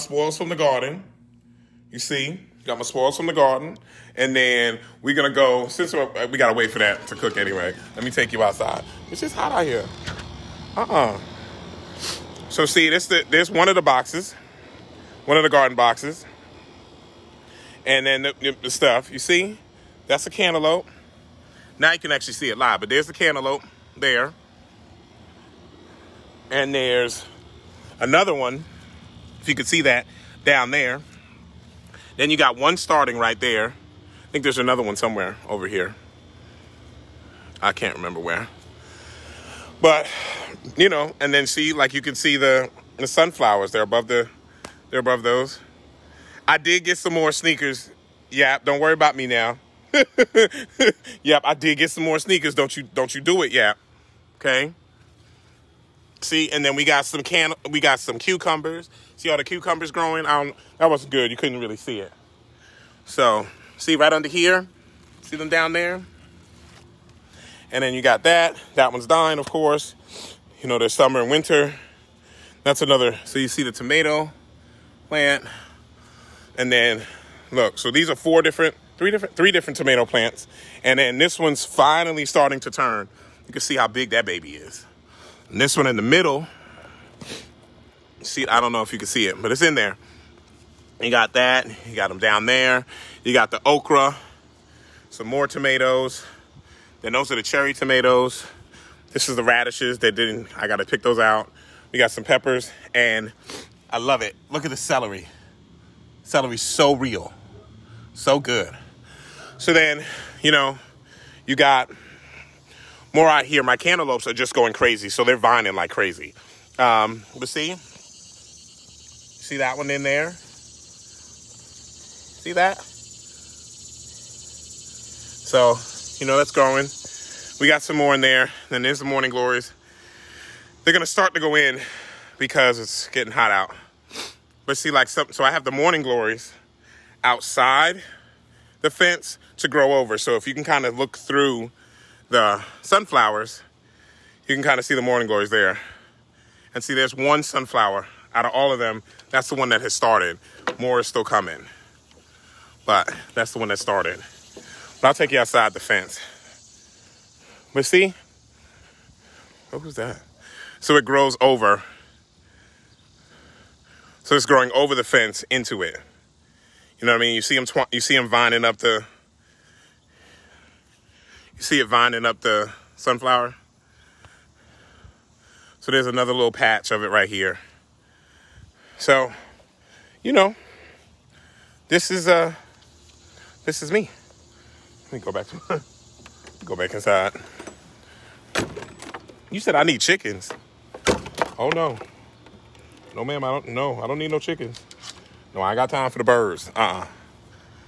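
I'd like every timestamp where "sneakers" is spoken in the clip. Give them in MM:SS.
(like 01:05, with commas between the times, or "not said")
00:47, 00:52.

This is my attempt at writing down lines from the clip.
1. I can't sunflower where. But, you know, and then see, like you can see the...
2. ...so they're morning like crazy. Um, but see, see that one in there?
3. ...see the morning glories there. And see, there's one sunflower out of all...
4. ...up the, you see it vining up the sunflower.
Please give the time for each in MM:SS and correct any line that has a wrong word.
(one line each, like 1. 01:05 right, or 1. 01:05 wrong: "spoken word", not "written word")
1. 00:37 wrong: "remember", not "sunflower"
2. 01:55 wrong: "vining", not "morning"
3. 02:24 right
4. 02:48 right.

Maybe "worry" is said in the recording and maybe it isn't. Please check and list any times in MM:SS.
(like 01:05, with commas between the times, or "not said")
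00:48.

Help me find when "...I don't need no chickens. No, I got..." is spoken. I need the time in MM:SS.
03:13.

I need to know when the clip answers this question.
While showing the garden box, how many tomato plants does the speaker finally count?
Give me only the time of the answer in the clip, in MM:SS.
01:19.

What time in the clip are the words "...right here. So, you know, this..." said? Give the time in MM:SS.
02:57.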